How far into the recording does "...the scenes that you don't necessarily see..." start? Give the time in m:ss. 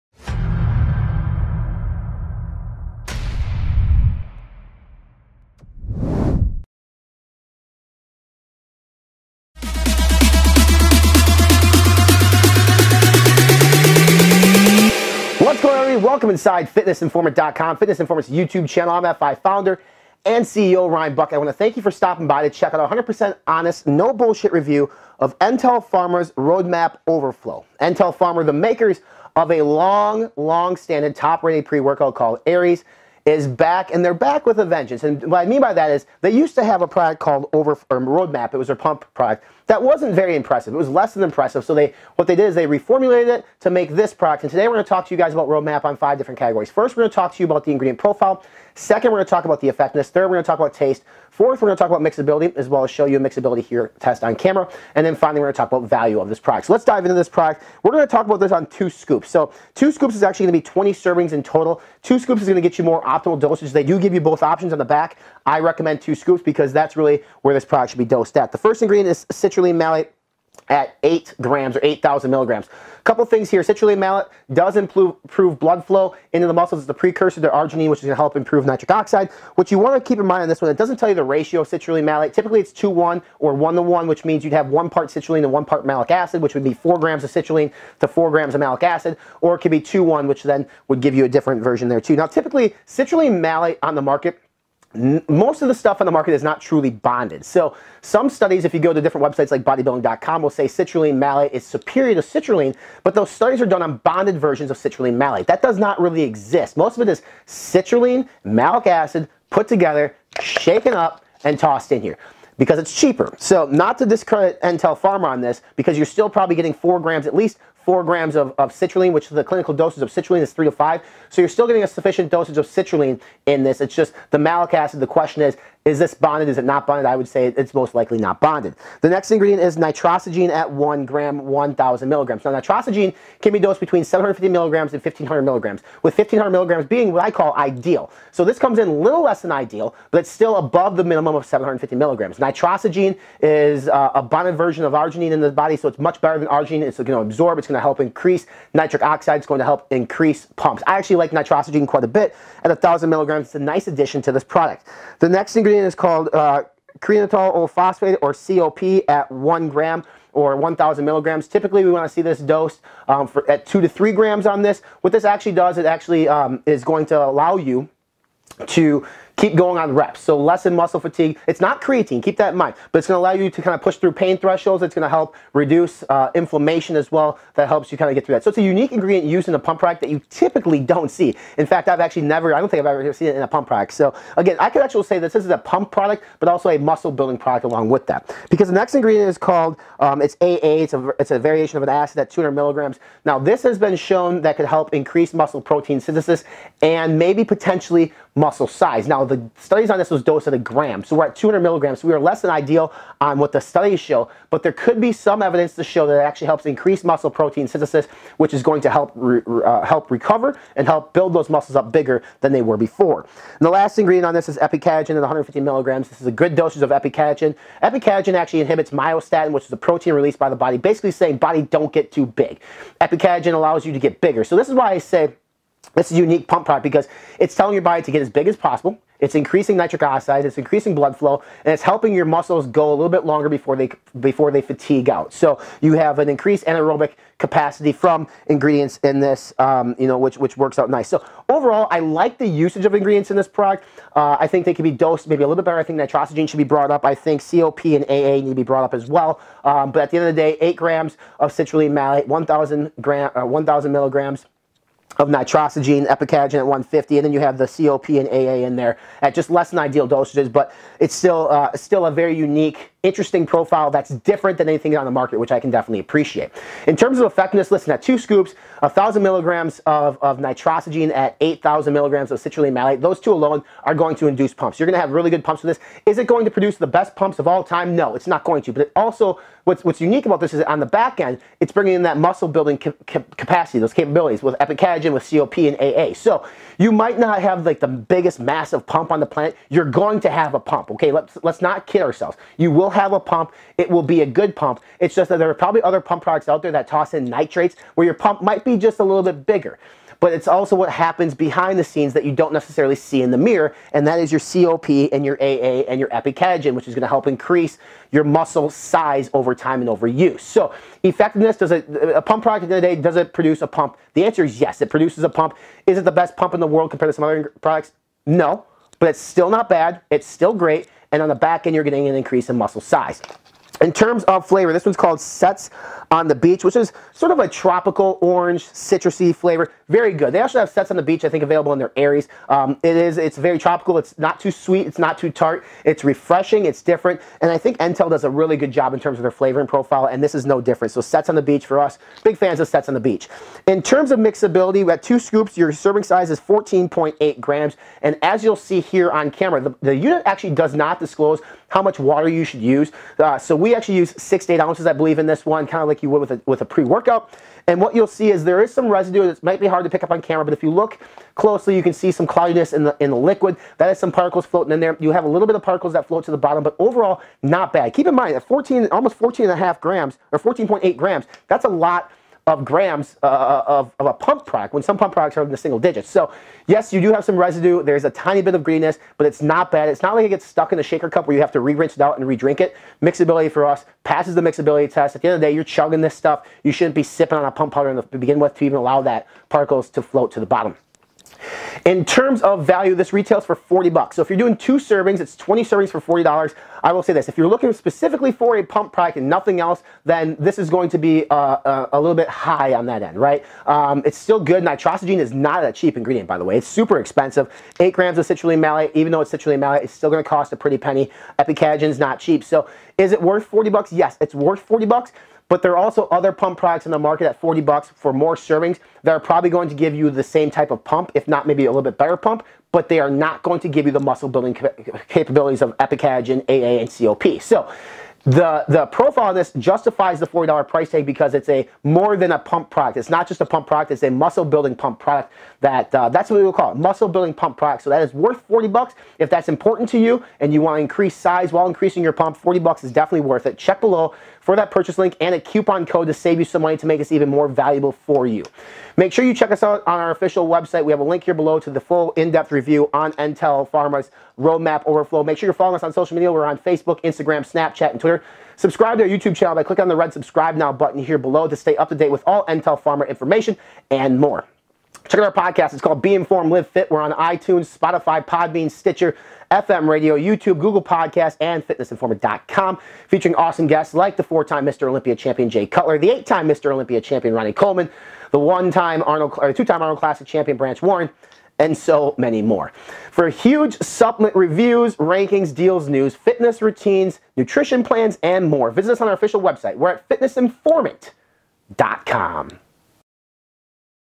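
5:01.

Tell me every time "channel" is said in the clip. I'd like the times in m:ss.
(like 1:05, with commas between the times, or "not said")
0:18, 7:39.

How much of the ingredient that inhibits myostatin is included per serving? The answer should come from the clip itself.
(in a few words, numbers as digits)
150 milligrams.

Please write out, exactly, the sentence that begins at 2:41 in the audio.
Typically, we want to see this dose um, for, at two to three grams on this.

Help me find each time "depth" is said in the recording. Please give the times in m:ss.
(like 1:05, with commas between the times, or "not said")
7:32.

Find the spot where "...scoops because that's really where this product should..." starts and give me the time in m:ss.
1:06.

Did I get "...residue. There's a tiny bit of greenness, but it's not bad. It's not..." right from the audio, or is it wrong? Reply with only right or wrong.
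right.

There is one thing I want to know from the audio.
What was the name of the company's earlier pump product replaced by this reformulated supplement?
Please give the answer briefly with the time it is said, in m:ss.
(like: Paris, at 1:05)
Over Roadmap, at 0:37.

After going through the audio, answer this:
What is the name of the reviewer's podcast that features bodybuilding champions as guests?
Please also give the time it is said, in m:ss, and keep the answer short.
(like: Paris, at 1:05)
Be Informed, Live Fit, at 7:46.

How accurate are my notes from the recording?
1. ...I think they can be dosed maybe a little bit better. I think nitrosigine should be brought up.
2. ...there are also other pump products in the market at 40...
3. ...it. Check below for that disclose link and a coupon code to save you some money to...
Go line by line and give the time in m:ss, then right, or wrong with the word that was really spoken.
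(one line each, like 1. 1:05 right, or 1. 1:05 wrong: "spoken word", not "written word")
1. 4:04 right
2. 6:55 right
3. 7:23 wrong: "purchase", not "disclose".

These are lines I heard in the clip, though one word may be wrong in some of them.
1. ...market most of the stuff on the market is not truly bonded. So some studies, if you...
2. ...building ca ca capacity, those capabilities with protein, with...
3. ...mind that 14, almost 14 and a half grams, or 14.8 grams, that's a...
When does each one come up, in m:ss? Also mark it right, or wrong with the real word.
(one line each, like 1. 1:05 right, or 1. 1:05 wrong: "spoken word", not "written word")
1. 1:34 right
2. 4:42 wrong: "epicatechin", not "protein"
3. 6:08 right.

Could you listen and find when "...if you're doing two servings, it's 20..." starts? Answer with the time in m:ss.
6:34.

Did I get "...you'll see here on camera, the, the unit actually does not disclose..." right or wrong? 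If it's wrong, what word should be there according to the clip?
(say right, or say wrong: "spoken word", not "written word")
right.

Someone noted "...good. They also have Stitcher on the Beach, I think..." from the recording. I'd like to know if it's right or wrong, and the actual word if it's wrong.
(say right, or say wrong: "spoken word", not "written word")
wrong: "Sets", not "Stitcher".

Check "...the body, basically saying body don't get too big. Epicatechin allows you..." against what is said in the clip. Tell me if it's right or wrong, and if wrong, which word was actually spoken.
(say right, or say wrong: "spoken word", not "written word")
right.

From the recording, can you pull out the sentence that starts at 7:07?
So the, the profile of this justifies the $40 price tag because it's a more than a pump product.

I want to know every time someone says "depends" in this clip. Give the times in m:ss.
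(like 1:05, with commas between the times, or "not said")
not said.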